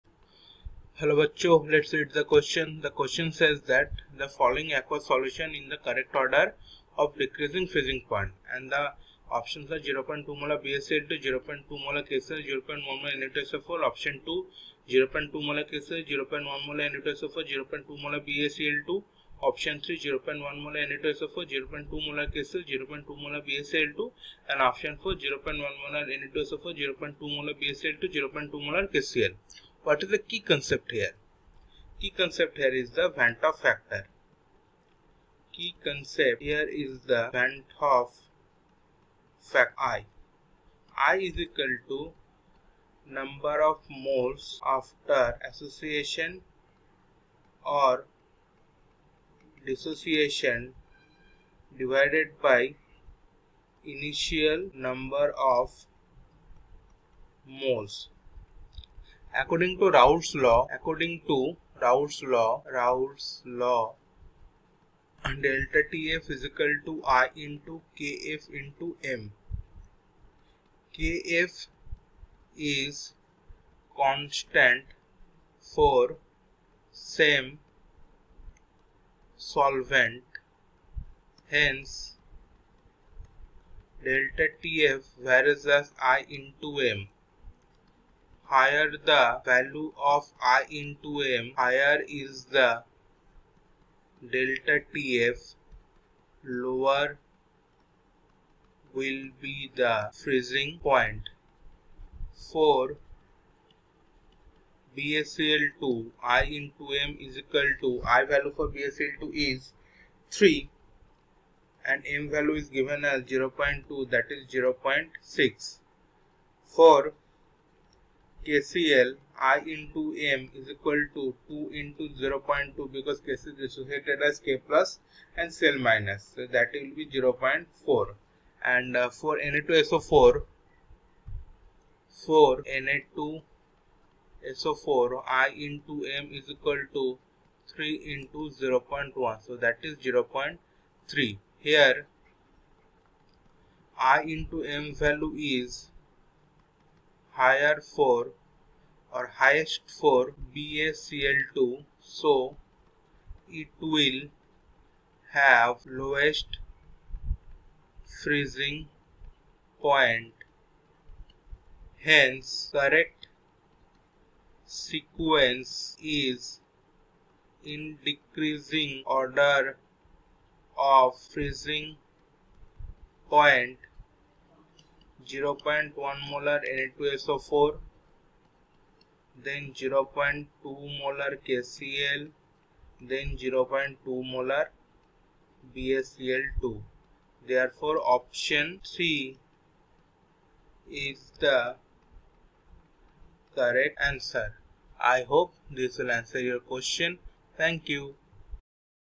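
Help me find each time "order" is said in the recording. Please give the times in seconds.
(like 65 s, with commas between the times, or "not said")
6 s, 169 s.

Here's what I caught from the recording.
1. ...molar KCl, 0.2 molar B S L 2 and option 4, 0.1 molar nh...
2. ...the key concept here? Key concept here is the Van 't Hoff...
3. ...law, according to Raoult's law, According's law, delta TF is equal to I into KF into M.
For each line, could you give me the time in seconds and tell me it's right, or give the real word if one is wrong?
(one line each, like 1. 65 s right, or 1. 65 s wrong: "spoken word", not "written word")
1. 22 s right
2. 30 s right
3. 60 s wrong: "Raoult", not "According".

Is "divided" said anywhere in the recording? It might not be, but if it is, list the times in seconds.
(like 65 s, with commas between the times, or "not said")
51 s.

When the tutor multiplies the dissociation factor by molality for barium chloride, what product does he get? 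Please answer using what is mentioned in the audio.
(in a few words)
0.6.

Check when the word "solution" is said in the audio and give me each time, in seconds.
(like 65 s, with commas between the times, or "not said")
5 s.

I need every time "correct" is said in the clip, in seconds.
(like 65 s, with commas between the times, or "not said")
5 s, 162 s, 193 s.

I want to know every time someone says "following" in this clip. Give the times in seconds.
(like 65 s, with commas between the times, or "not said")
4 s.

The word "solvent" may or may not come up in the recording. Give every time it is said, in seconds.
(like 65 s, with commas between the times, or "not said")
79 s.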